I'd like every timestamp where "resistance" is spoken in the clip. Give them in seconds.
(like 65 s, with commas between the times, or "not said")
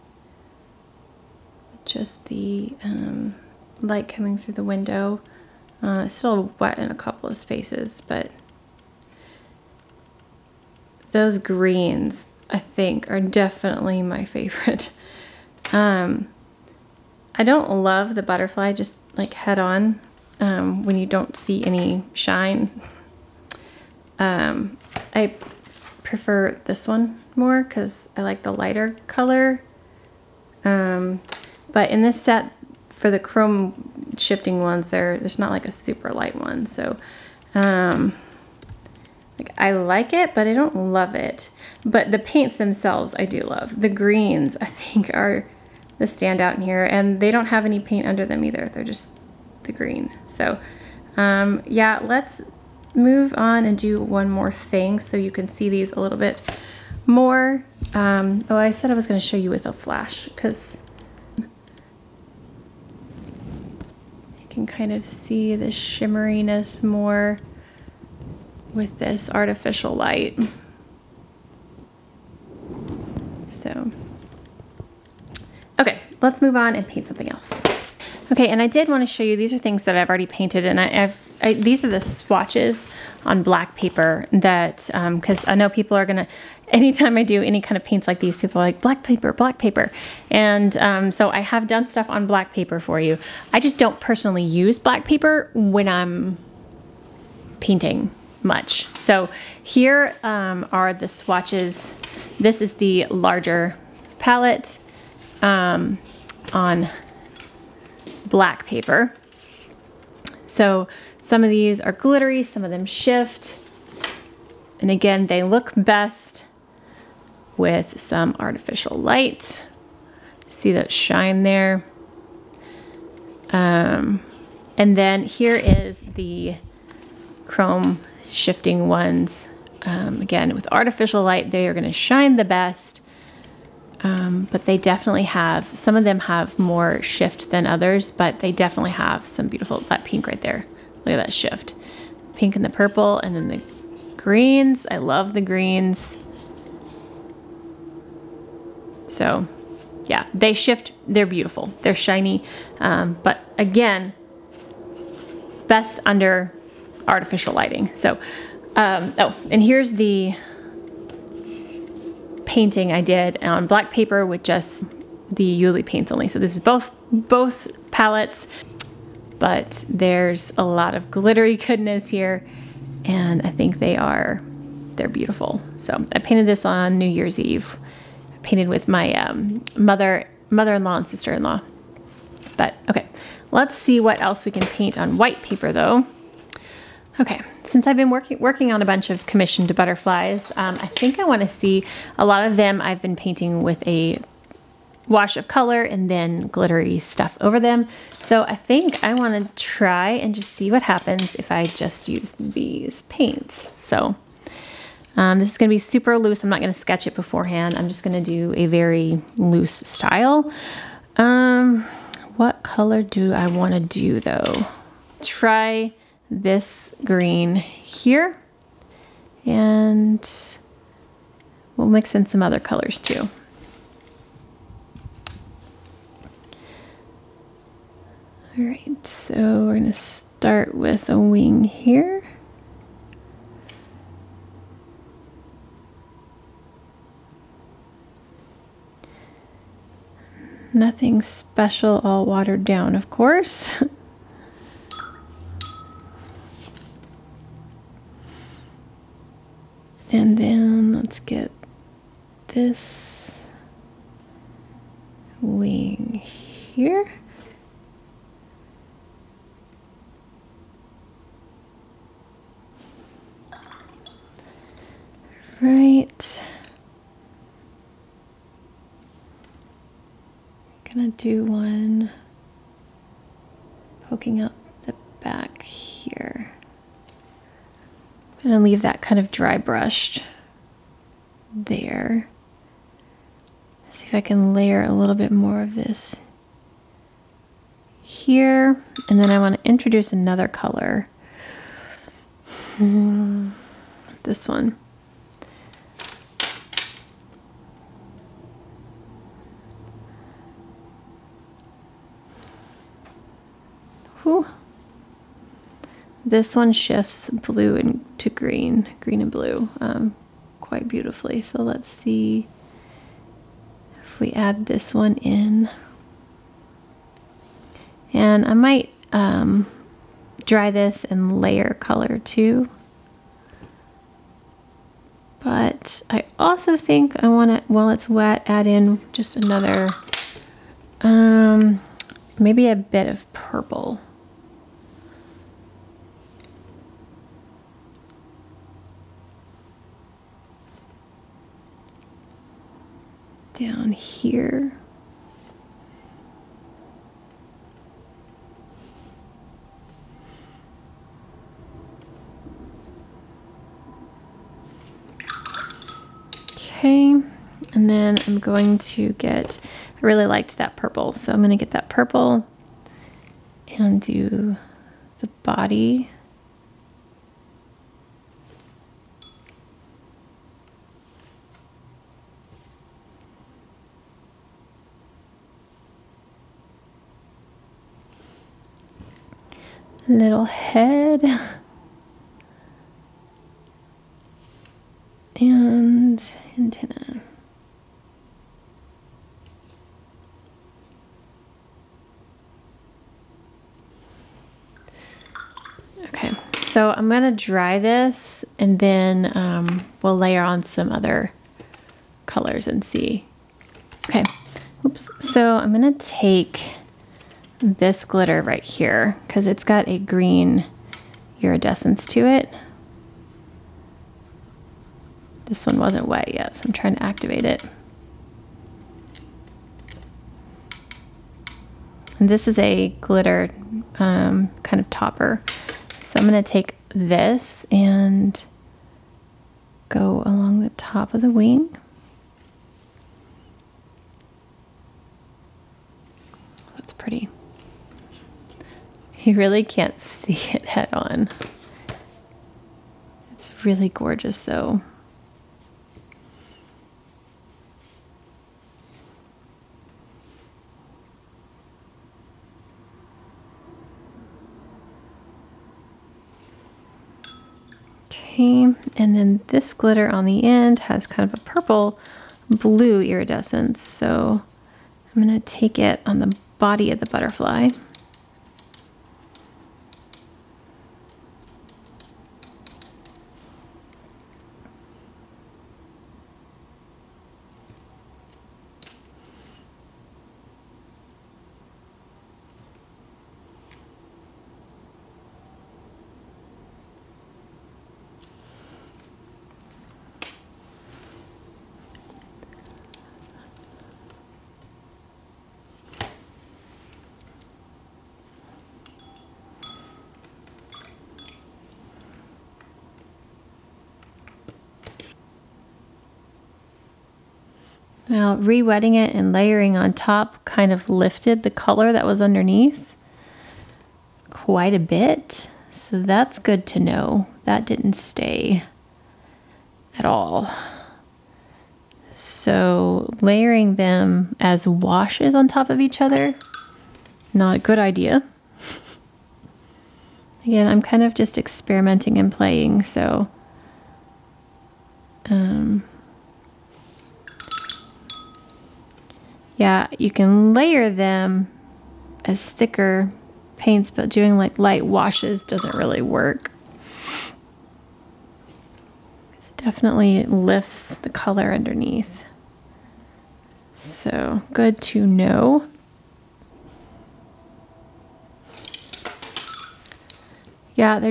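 not said.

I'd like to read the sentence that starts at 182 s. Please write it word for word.
But okay, let's see what else we can paint on white paper though.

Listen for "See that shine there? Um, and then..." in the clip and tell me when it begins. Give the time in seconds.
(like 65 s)
120 s.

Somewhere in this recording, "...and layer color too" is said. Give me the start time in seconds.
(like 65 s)
321 s.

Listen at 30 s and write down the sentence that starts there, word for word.
Um, but in this set, for the chrome shifting ones, there there's not like a super light one.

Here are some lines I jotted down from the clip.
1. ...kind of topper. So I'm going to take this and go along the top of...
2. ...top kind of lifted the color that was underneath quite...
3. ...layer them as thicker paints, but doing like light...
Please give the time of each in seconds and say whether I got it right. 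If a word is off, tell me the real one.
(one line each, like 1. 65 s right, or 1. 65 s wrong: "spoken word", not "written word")
1. 424 s right
2. 509 s right
3. 540 s right.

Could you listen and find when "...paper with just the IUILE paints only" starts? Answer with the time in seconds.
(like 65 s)
163 s.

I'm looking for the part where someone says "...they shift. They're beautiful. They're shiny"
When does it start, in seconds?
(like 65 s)
150 s.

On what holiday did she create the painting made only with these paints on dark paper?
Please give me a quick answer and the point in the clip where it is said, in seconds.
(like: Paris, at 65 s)
New Year's Eve, at 176 s.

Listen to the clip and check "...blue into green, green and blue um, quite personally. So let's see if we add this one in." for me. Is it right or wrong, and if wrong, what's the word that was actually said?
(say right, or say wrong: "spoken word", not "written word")
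wrong: "beautifully", not "personally".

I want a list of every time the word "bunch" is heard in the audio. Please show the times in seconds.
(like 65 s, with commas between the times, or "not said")
188 s.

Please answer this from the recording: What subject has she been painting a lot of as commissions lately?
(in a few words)
Butterflies.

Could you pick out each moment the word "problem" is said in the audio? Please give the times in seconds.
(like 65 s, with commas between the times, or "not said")
not said.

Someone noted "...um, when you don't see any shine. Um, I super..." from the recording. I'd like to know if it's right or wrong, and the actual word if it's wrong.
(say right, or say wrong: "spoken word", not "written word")
wrong: "prefer", not "super".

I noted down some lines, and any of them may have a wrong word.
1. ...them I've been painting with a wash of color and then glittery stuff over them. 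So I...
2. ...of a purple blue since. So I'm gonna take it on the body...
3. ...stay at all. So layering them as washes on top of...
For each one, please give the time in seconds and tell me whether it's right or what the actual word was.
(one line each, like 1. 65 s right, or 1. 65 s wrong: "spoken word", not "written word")
1. 192 s right
2. 461 s wrong: "iridescence", not "since"
3. 517 s right.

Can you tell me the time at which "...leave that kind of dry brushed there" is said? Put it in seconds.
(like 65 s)
278 s.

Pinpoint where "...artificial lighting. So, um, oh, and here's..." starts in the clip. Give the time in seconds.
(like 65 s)
157 s.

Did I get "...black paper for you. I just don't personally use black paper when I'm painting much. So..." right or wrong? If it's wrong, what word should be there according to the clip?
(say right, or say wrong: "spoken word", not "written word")
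right.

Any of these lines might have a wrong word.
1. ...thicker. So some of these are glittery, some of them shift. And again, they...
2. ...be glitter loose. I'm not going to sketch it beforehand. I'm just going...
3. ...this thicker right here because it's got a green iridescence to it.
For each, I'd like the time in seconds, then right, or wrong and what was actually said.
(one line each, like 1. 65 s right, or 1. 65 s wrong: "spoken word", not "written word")
1. 108 s wrong: "paper", not "thicker"
2. 205 s wrong: "super", not "glitter"
3. 407 s wrong: "glitter", not "thicker".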